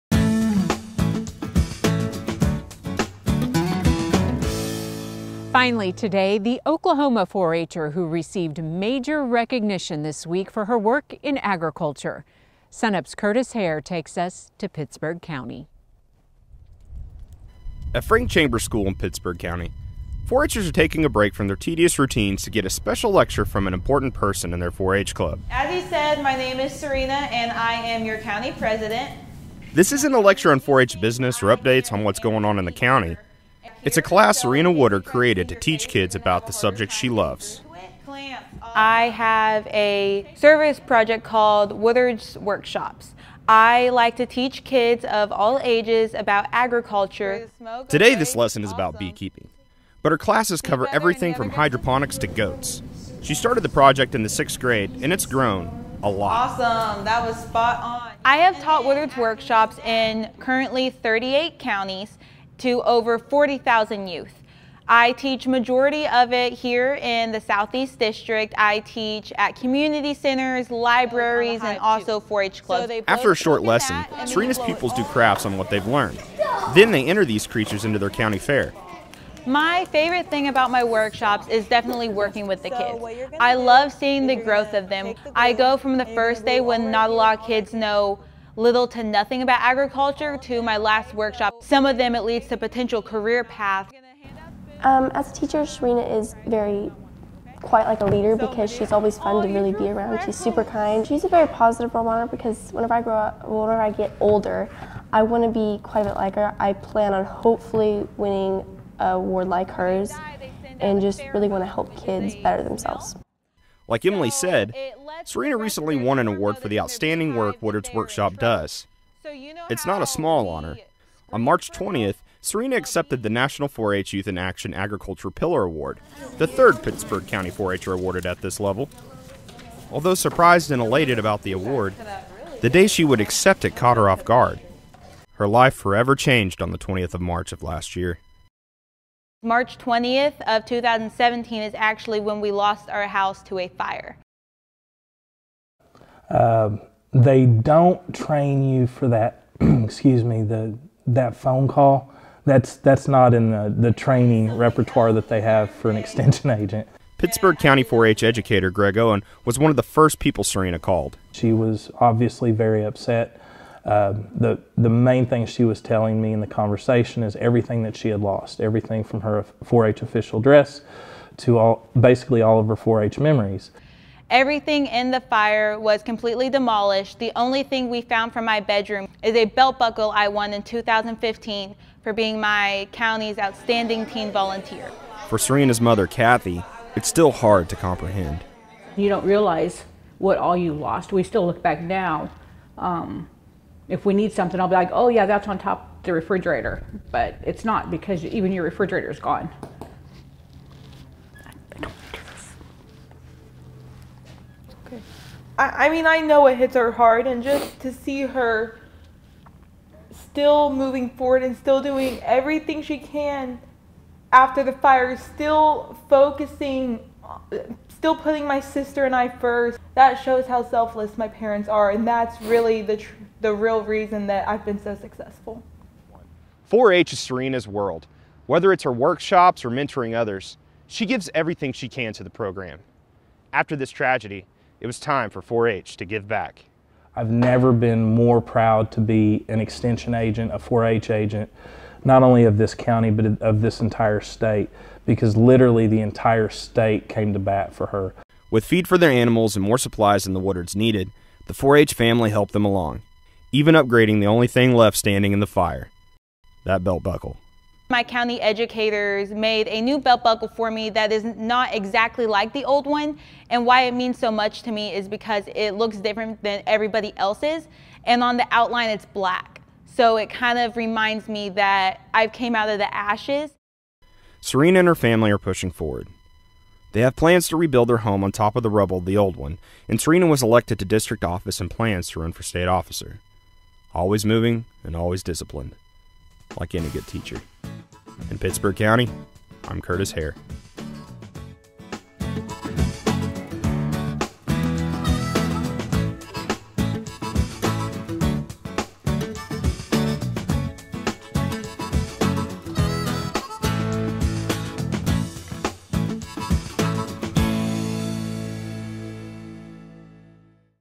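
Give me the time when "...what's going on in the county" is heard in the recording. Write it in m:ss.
0:32.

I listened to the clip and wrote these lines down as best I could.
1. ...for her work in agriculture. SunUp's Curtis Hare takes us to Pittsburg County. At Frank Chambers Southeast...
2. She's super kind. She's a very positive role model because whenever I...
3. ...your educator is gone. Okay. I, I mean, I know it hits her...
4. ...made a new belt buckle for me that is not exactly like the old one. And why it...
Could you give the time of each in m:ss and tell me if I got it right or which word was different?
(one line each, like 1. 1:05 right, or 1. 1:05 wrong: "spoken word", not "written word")
1. 0:10 wrong: "School", not "Southeast"
2. 1:40 right
3. 3:18 wrong: "refrigerator", not "educator"
4. 4:19 right.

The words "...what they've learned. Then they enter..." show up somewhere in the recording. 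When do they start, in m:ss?
1:15.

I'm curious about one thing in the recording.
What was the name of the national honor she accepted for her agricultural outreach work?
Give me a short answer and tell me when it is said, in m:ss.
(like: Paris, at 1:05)
Youth in Action Agriculture Pillar Award, at 2:04.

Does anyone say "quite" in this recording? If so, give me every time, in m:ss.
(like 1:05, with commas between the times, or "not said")
1:37, 1:45.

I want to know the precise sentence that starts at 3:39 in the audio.
That shows how selfless my parents are, and that's really the, the real reason that I've been so successful.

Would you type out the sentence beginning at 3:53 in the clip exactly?
After this tragedy, it was time for 4 H to give back.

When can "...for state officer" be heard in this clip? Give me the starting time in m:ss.
4:42.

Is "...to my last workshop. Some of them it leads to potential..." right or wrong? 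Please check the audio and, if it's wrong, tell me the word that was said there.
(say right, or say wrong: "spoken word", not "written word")
right.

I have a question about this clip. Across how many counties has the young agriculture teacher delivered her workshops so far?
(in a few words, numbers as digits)
38.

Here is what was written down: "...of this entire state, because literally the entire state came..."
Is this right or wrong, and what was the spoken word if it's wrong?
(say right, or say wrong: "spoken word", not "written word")
right.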